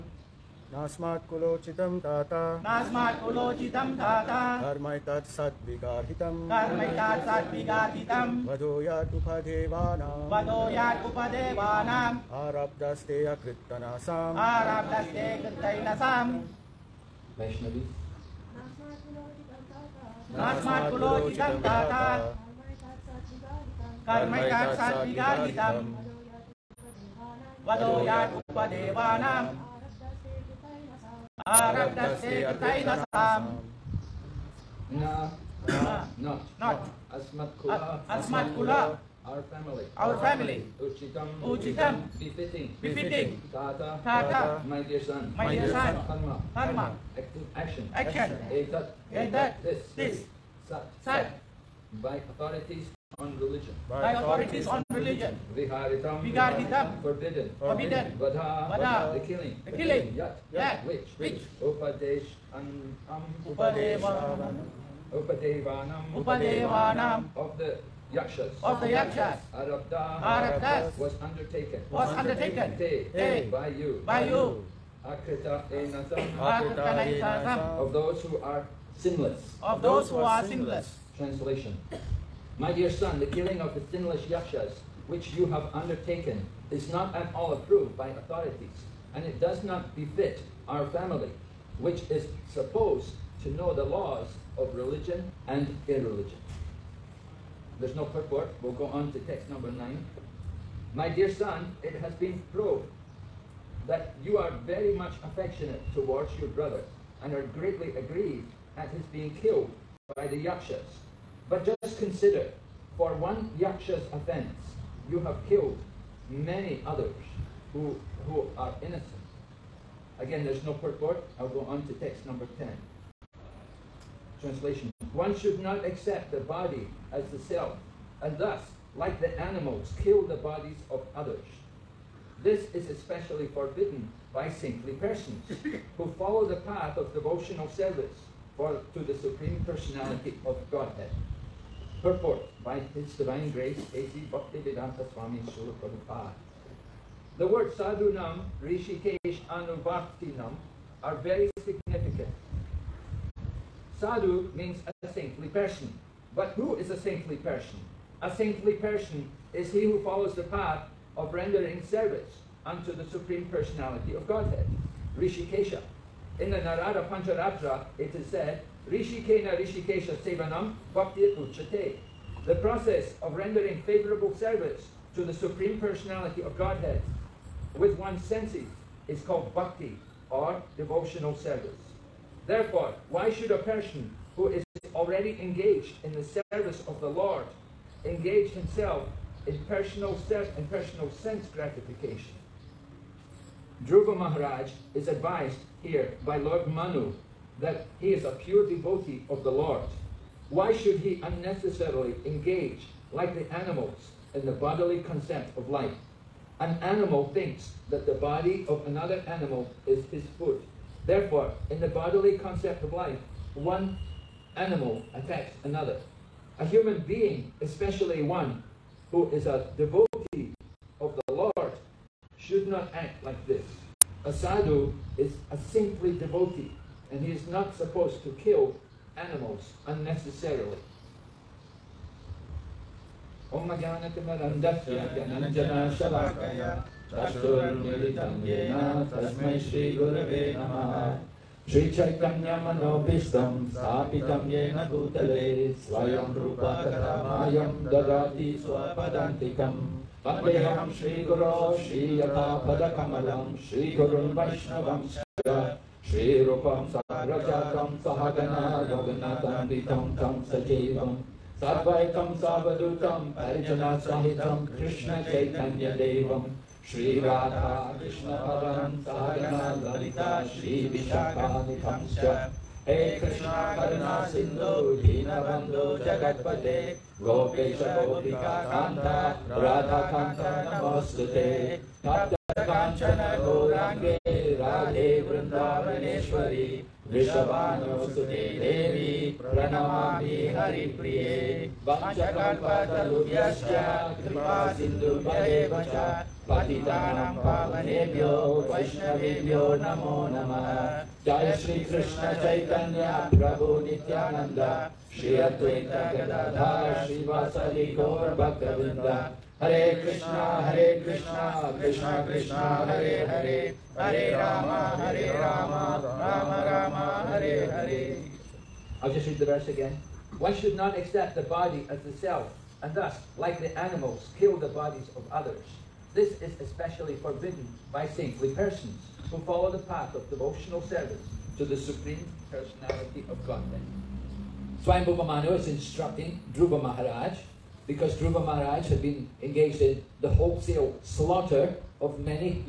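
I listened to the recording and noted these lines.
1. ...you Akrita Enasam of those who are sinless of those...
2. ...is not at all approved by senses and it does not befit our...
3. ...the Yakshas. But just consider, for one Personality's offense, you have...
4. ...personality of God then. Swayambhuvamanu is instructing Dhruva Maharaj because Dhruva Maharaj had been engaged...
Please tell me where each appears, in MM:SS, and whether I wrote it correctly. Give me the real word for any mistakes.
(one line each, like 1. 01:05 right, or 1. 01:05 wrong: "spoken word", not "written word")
1. 01:14 right
2. 01:26 wrong: "authorities", not "senses"
3. 01:50 wrong: "Yaksha", not "Personality"
4. 05:32 right.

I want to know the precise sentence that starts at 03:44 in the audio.
A sadhu is a saintly devotee, and he is not supposed to kill animals unnecessarily.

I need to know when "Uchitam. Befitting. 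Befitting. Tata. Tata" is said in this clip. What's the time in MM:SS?
00:41.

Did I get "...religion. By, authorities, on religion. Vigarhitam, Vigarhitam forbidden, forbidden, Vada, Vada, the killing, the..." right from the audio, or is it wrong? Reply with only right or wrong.
right.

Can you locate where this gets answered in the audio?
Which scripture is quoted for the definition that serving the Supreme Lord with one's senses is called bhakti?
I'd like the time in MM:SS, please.
02:46.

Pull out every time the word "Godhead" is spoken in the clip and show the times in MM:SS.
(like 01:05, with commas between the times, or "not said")
02:20, 02:44, 02:56.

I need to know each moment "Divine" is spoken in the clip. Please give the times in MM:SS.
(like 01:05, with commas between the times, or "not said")
02:23.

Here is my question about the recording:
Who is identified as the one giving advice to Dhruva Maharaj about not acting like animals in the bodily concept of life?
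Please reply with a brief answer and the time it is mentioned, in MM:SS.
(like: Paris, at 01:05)
Lord Manu, at 03:16.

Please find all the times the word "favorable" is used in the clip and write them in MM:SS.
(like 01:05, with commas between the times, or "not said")
02:53.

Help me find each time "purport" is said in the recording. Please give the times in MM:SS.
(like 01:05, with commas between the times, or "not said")
01:38, 02:00, 02:22.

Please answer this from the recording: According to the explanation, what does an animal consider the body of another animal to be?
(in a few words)
His food.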